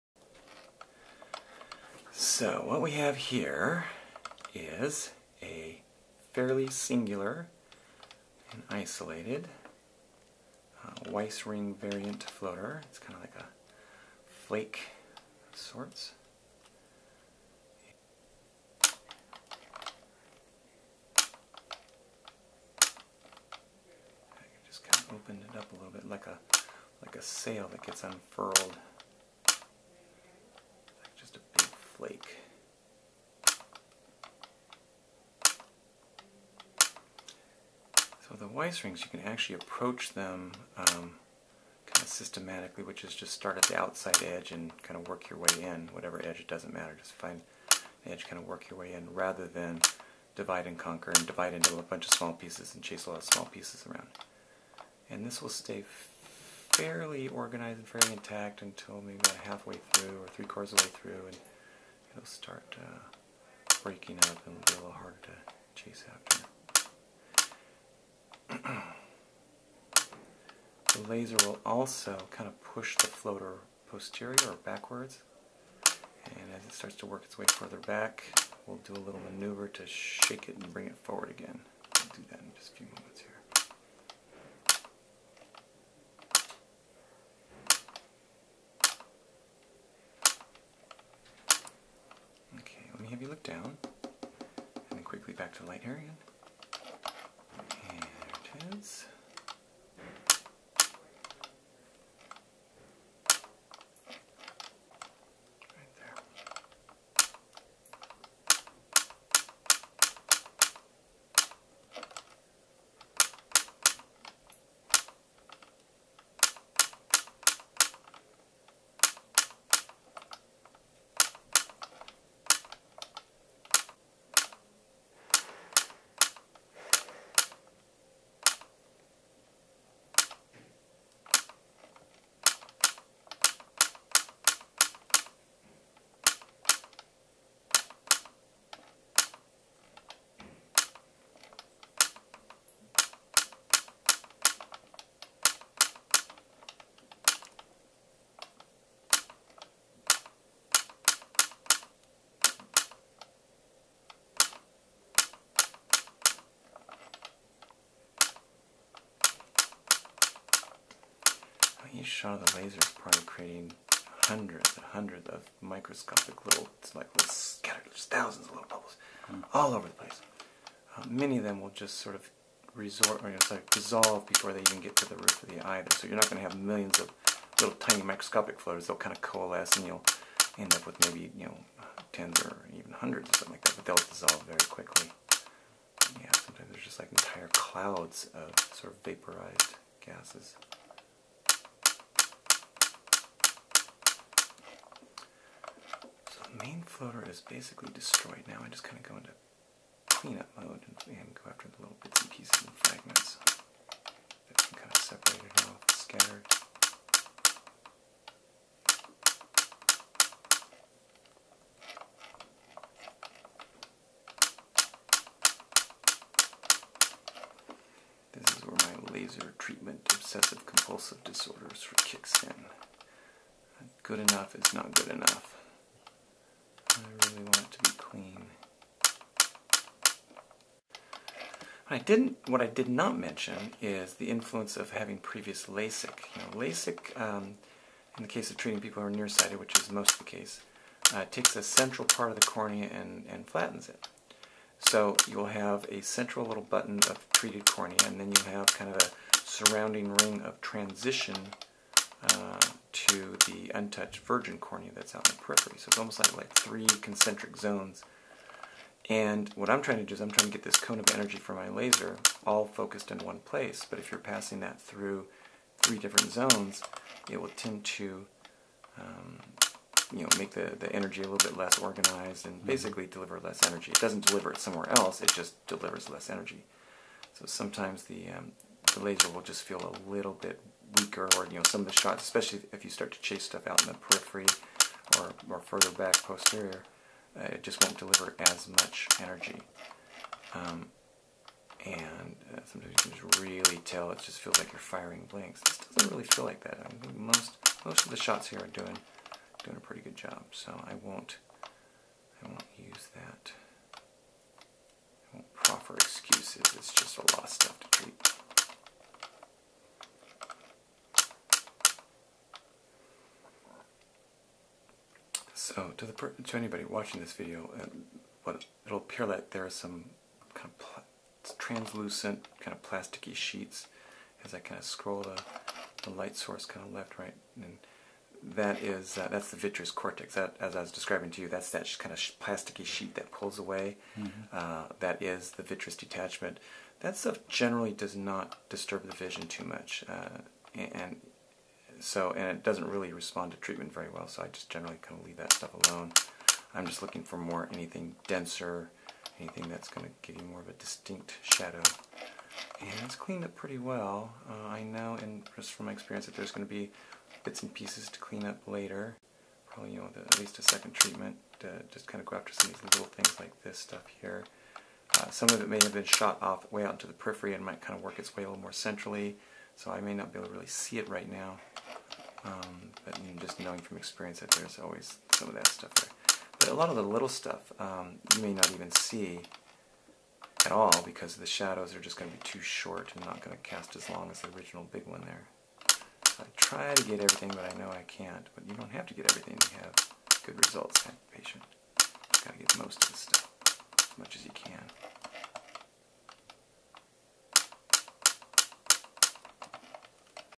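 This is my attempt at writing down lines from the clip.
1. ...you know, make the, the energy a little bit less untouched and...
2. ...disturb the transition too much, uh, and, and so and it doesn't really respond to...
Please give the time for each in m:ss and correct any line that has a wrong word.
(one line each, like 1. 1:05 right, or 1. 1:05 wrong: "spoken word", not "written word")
1. 4:30 wrong: "organized", not "untouched"
2. 5:38 wrong: "vision", not "transition".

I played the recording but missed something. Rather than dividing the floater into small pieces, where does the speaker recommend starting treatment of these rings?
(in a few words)
the outside edge.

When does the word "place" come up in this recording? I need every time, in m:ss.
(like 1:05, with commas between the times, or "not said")
2:49, 4:23.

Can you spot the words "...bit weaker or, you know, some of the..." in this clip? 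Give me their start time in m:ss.
4:40.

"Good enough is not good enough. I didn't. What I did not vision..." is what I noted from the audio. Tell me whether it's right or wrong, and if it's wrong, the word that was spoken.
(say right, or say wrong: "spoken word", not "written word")
wrong: "mention", not "vision".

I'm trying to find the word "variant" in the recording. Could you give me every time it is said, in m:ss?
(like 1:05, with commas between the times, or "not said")
0:11.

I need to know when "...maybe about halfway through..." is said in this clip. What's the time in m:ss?
0:59.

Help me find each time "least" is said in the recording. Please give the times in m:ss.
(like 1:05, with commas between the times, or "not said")
6:00.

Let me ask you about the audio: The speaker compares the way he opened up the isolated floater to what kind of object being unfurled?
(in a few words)
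a sail.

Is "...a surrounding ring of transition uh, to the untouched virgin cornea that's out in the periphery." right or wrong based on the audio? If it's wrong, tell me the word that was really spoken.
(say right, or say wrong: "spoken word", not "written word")
right.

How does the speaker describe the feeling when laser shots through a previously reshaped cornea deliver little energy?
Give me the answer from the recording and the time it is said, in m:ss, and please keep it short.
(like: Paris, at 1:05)
firing blanks, at 4:54.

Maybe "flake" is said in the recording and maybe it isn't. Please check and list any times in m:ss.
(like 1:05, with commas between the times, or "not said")
0:14, 0:32.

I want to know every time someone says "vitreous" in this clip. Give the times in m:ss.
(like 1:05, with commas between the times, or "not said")
5:29, 5:35.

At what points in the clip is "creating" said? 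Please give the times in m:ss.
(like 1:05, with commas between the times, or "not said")
2:43.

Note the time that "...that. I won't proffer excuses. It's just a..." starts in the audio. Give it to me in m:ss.
5:03.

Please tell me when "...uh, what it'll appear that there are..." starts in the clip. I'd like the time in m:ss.
5:17.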